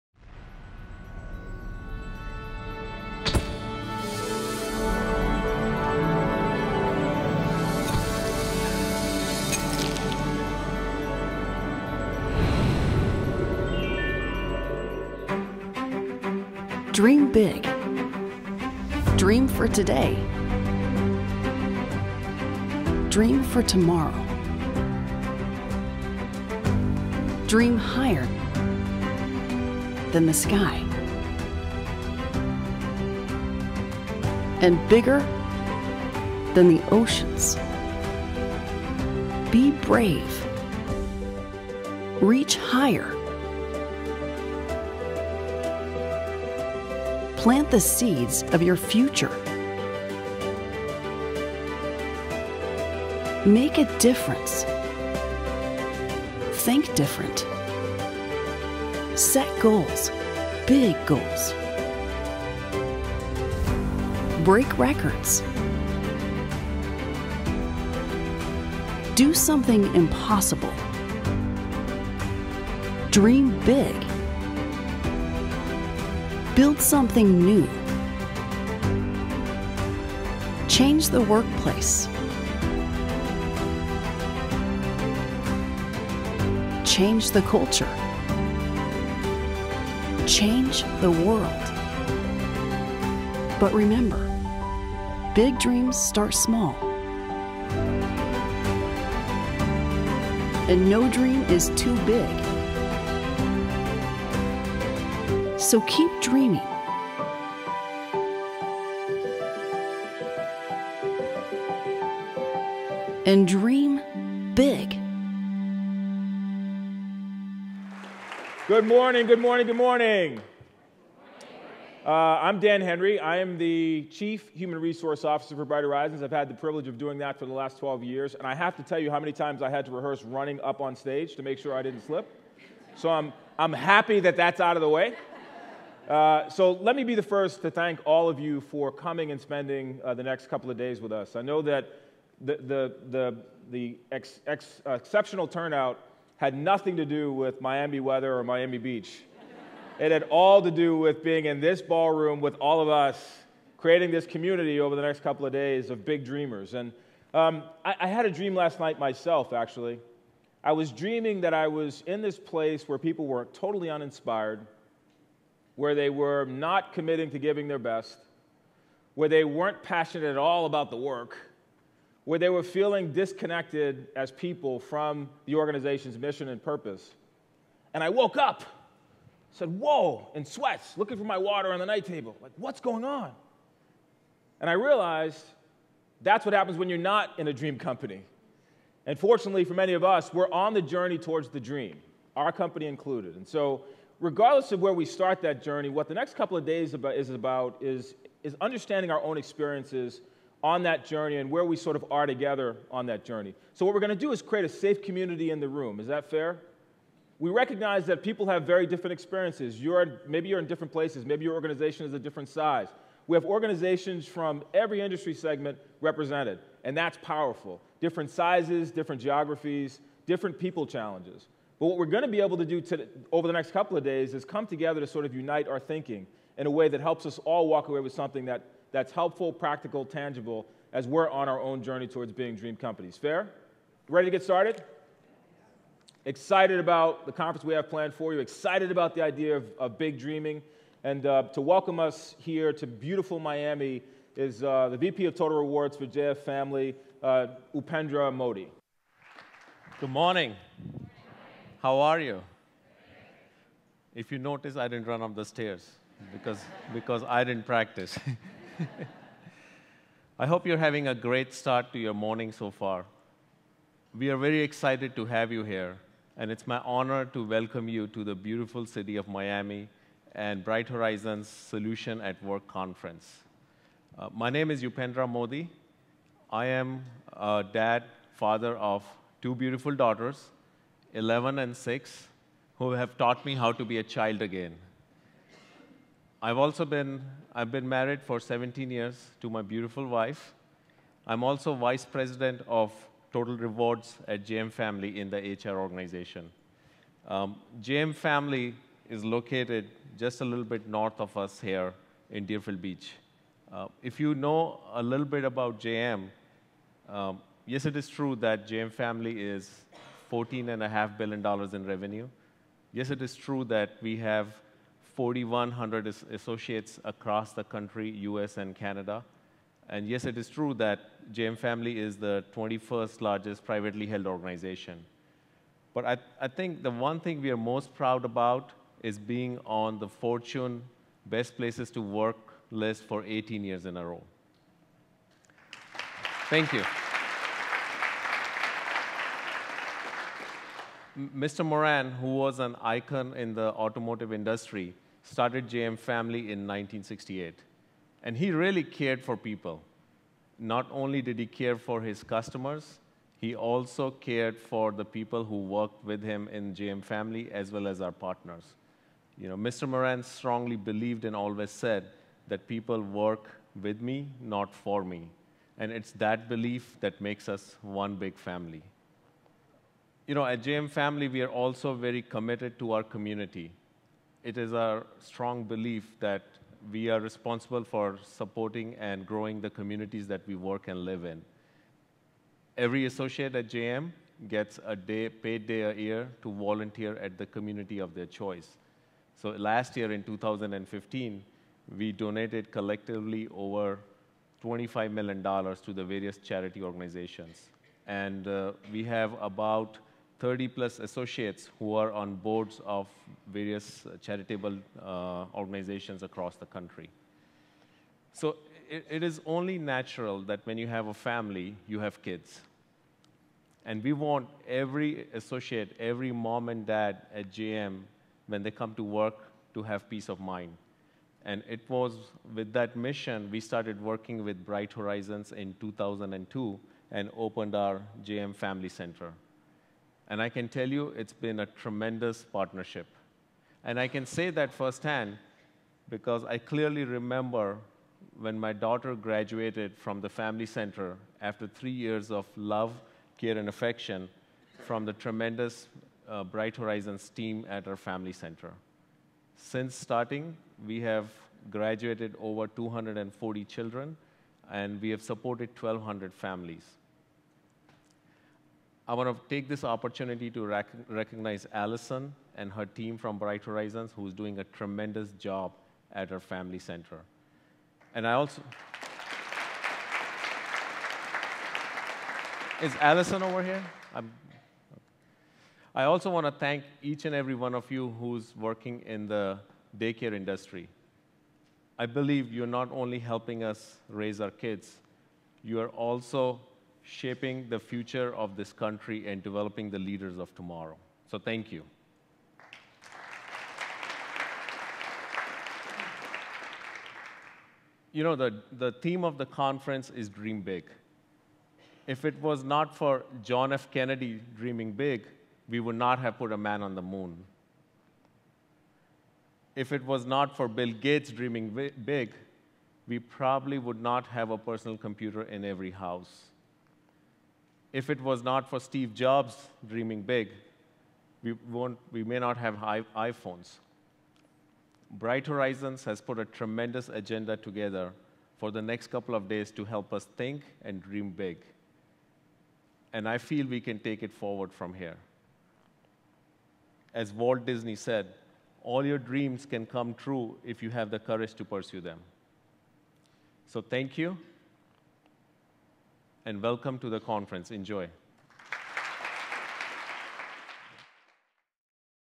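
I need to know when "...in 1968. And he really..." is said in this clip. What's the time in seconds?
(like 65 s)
346 s.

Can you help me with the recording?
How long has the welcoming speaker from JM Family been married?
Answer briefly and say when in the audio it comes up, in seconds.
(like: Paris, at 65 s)
17 years, at 288 s.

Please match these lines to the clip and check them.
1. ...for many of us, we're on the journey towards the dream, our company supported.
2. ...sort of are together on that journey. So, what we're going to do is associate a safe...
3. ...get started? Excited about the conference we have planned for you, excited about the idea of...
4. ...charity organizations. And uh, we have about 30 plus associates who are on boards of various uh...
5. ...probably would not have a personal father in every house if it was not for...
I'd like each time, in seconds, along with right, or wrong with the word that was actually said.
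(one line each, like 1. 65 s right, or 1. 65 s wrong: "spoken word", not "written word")
1. 189 s wrong: "included", not "supported"
2. 201 s wrong: "create", not "associate"
3. 234 s right
4. 396 s right
5. 513 s wrong: "computer", not "father".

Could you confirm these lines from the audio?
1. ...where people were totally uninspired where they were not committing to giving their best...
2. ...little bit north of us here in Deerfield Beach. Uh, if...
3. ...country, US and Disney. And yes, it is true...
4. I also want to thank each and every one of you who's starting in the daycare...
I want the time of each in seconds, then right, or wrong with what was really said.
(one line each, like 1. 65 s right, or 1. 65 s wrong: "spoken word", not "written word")
1. 162 s right
2. 300 s right
3. 317 s wrong: "Canada", not "Disney"
4. 475 s wrong: "working", not "starting".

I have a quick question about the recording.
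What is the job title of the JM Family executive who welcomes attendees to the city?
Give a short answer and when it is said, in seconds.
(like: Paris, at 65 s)
VP of Total Rewards, at 244 s.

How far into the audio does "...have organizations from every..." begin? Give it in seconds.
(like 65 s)
213 s.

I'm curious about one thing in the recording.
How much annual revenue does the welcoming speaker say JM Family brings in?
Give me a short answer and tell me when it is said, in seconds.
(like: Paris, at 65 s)
$14.5 billion, at 310 s.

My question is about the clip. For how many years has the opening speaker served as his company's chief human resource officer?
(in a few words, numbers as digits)
12.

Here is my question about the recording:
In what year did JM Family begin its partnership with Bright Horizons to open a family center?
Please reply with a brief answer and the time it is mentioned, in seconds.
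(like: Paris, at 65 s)
2002, at 425 s.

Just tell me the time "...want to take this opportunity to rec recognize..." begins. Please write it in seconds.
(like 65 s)
459 s.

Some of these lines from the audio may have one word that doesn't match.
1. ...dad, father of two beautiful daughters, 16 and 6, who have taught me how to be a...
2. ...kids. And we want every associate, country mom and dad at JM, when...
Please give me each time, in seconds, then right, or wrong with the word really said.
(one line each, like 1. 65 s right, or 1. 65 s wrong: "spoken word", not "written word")
1. 277 s wrong: "11", not "16"
2. 412 s wrong: "every", not "country".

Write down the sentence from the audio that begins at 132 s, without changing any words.
So I'm, I'm happy that that's out of the way.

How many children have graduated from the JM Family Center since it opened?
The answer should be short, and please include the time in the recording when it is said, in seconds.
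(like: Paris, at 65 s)
240, at 452 s.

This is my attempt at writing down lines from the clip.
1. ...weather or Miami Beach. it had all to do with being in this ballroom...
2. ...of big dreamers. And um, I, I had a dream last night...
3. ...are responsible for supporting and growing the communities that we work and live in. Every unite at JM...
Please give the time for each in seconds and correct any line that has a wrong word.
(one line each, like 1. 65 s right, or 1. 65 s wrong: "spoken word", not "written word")
1. 148 s right
2. 155 s right
3. 377 s wrong: "associate", not "unite".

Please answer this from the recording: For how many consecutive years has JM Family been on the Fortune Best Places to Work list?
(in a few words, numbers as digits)
18.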